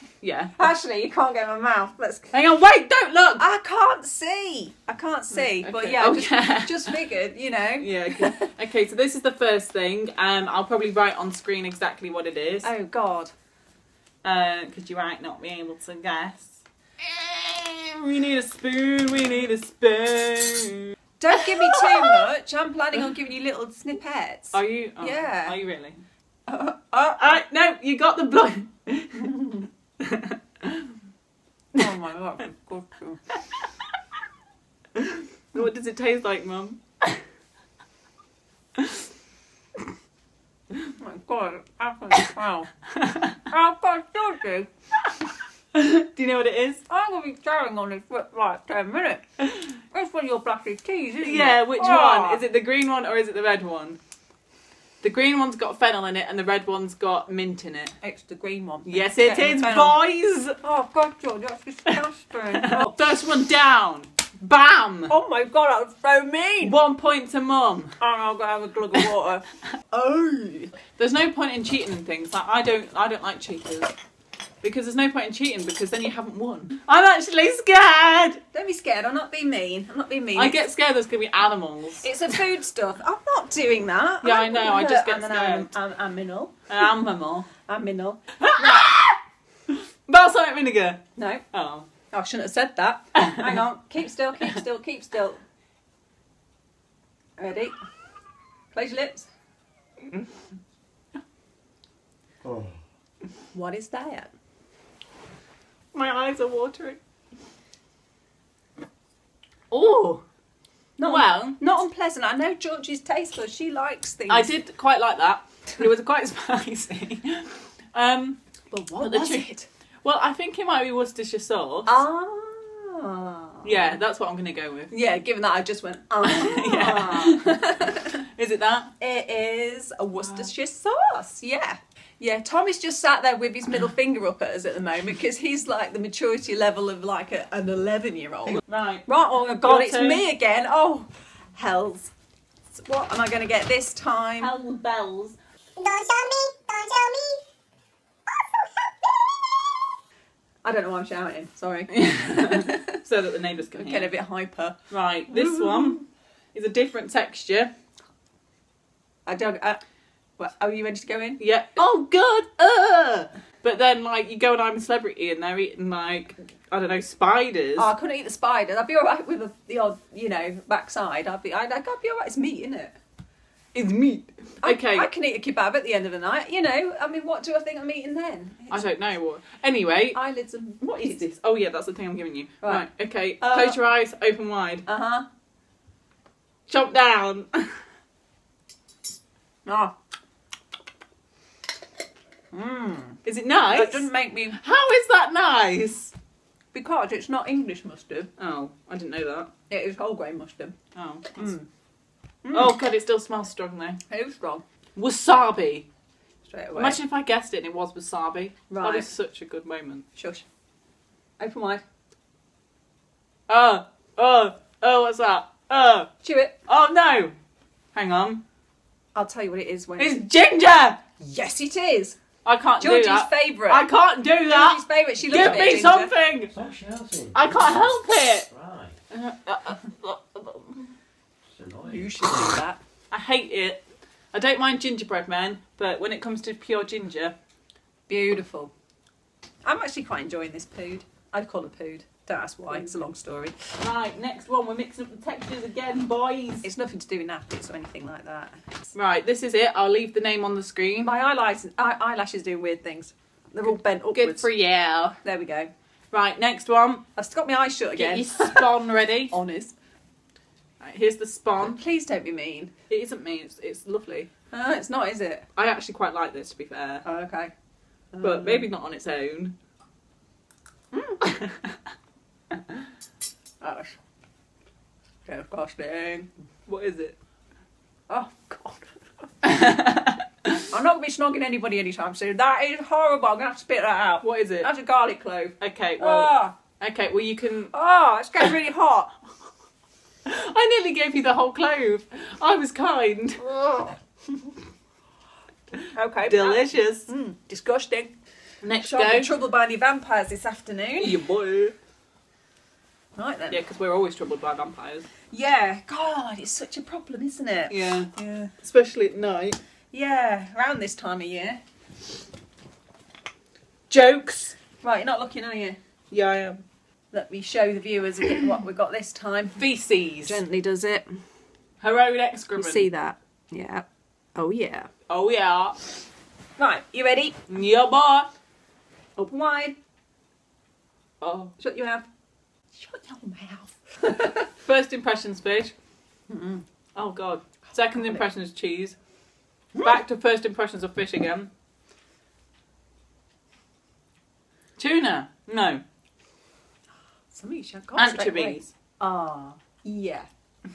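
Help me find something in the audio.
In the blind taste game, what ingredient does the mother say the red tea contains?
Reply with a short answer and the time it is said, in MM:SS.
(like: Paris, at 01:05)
Mint, at 00:57.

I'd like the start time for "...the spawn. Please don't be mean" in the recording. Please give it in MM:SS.
04:21.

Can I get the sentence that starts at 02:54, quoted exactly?
I, can eat a kebab at the end of the night.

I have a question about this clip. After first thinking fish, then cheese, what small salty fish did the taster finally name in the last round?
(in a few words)
Anchovies.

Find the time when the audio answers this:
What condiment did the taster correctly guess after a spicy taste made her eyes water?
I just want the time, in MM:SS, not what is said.
02:00.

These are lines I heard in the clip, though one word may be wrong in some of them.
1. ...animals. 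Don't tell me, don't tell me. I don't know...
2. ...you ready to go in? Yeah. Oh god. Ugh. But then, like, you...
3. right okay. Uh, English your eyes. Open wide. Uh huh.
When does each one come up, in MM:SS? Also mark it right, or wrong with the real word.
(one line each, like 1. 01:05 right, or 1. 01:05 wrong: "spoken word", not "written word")
1. 02:24 wrong: "bells", not "animals"
2. 02:40 right
3. 03:02 wrong: "Close", not "English".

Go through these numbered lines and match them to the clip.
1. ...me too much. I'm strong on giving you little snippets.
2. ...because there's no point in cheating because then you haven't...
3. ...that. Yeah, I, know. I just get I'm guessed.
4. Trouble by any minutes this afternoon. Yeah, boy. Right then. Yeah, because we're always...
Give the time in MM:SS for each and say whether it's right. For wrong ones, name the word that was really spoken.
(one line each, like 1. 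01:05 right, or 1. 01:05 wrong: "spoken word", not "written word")
1. 00:21 wrong: "planning", not "strong"
2. 01:14 right
3. 01:23 wrong: "scared", not "guessed"
4. 04:59 wrong: "vampires", not "minutes".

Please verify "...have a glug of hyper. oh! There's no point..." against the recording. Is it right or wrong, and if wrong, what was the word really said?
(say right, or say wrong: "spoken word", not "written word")
wrong: "water", not "hyper".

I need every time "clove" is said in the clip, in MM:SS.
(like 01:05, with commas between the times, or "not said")
04:45, 04:51.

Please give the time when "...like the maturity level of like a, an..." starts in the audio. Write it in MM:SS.
02:15.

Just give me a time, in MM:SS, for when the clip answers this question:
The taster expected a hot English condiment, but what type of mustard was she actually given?
03:19.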